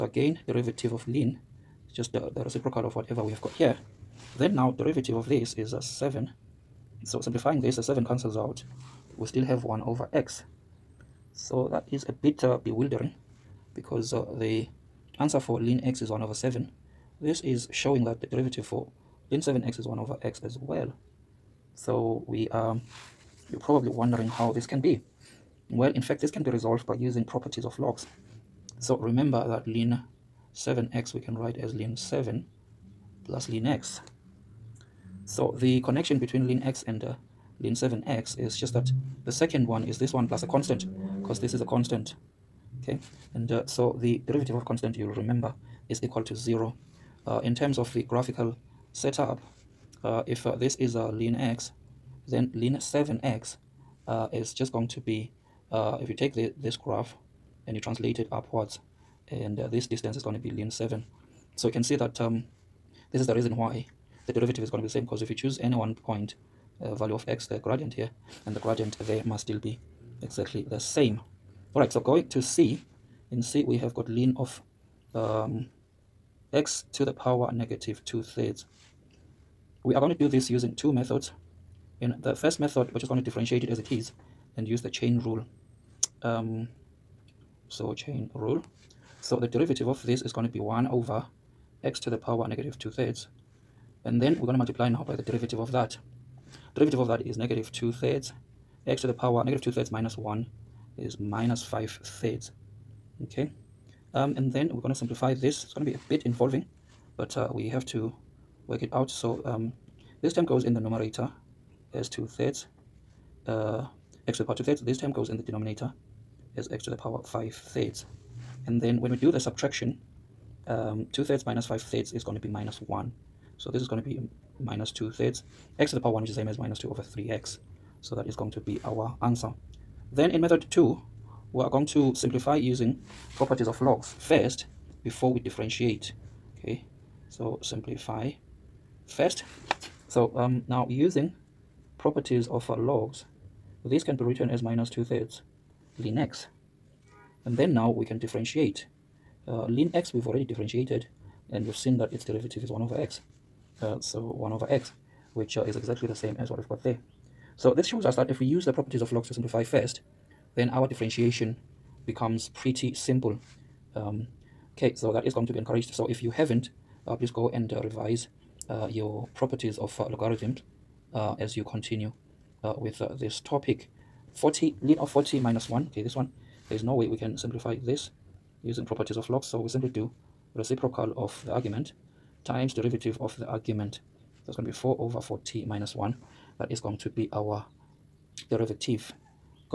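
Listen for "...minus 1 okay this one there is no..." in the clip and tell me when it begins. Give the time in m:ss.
2:55.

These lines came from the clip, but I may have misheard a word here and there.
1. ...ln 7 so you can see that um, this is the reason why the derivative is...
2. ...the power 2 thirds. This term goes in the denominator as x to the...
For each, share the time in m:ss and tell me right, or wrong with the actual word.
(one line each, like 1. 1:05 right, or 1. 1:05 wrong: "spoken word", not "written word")
1. 1:00 right
2. 1:54 right.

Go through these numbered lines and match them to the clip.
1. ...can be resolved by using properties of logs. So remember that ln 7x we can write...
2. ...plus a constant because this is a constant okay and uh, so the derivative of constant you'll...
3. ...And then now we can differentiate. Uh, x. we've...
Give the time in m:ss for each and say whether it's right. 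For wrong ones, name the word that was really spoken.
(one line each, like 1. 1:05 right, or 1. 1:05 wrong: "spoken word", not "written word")
1. 0:26 right
2. 0:40 right
3. 2:27 right.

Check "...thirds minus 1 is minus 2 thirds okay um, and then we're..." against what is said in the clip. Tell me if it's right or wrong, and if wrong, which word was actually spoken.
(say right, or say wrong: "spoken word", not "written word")
wrong: "5", not "2".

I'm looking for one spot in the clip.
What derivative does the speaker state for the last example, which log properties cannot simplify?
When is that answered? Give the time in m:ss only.
3:04.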